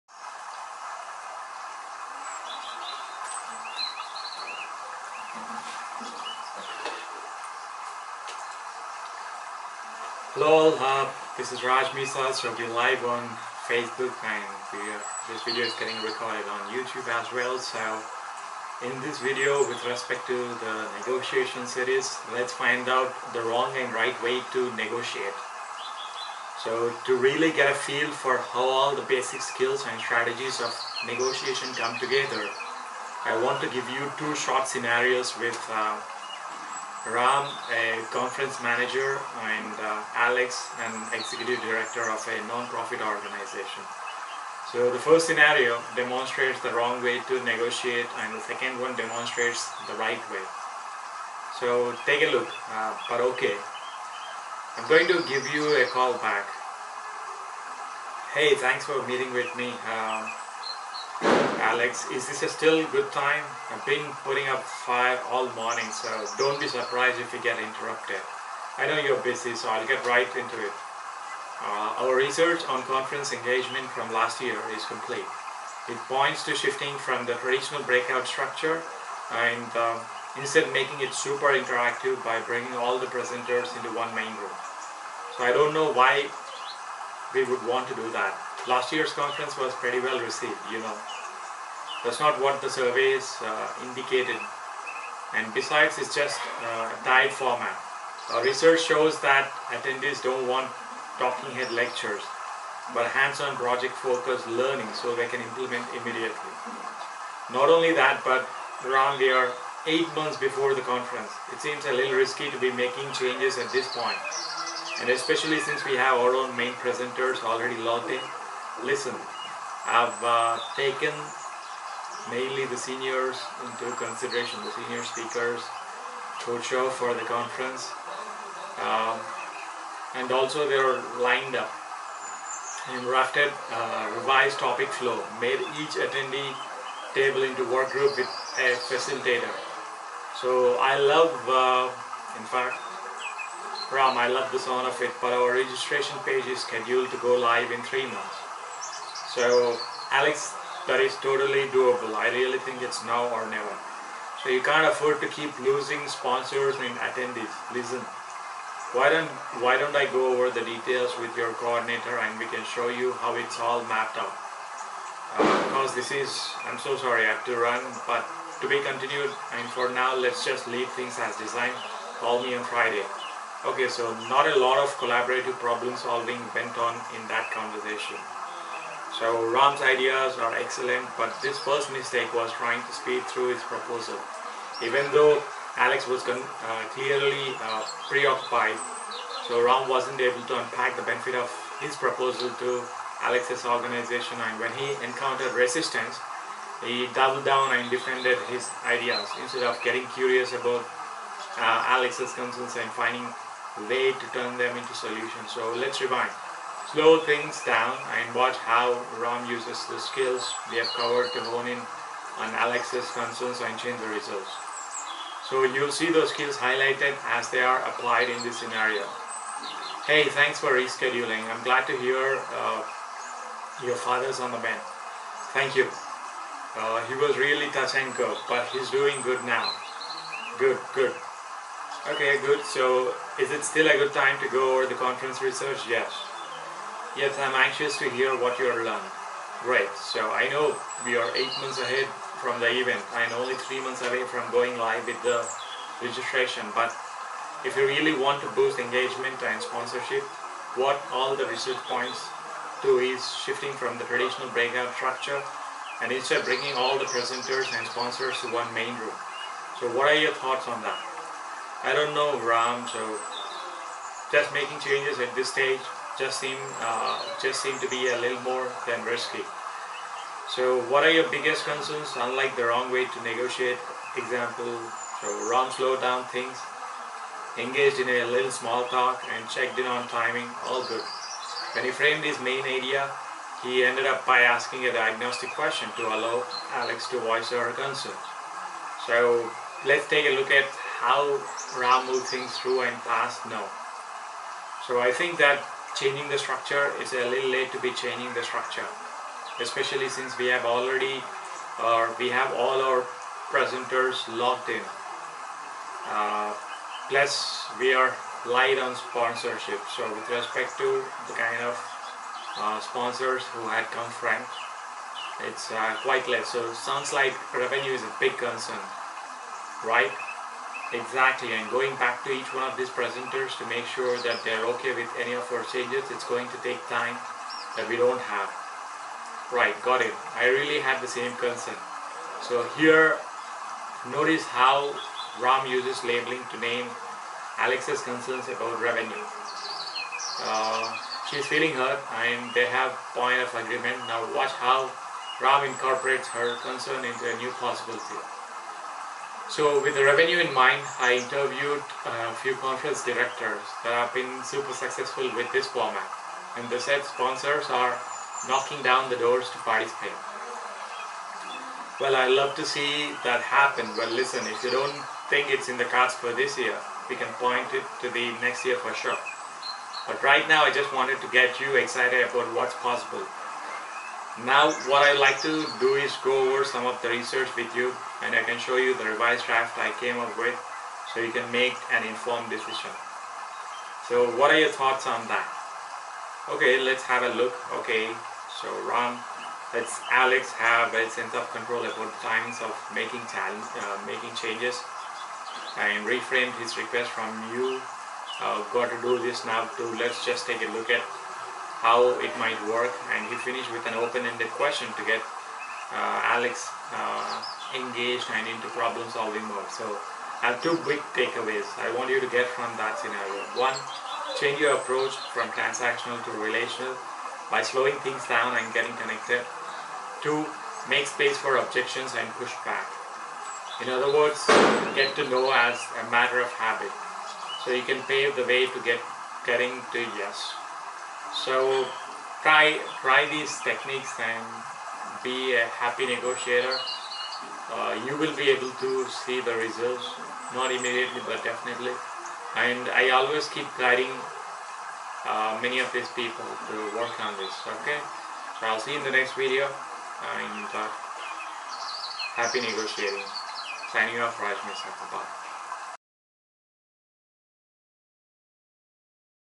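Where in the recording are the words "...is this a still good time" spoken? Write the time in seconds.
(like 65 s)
62 s.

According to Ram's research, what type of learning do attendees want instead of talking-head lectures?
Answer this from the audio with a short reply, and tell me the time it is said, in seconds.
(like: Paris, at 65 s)
hands-on project-focused learning, at 103 s.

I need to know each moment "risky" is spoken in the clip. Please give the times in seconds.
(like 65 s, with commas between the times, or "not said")
112 s, 269 s.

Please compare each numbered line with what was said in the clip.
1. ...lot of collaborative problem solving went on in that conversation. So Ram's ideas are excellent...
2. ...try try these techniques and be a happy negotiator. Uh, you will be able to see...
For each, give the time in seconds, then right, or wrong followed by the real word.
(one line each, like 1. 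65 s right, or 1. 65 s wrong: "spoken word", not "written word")
1. 174 s right
2. 432 s right.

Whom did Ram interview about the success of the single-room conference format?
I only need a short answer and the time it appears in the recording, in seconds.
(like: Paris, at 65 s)
conference directors, at 352 s.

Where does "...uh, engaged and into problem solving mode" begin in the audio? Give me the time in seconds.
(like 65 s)
406 s.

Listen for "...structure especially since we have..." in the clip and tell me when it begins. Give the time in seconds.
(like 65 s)
298 s.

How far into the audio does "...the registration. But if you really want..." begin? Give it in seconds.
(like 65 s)
245 s.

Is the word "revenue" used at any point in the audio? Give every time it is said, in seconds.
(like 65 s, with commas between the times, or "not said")
317 s, 338 s, 350 s.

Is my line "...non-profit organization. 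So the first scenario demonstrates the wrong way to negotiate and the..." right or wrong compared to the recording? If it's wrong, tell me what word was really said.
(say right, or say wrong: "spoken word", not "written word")
right.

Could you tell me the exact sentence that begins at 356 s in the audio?
And the said sponsors are knocking down the doors to participate.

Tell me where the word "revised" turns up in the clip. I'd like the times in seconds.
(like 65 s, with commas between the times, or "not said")
134 s, 379 s.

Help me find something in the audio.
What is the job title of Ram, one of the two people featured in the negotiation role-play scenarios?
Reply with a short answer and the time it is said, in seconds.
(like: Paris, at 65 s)
conference manager, at 37 s.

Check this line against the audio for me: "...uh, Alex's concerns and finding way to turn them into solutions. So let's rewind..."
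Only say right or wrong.
right.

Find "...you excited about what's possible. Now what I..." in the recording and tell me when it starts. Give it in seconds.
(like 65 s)
371 s.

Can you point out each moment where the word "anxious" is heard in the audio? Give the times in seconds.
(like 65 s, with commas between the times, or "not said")
237 s.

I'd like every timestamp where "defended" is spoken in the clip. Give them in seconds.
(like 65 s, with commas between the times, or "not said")
197 s.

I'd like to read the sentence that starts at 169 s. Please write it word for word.
And for now, let's just leave things as designed.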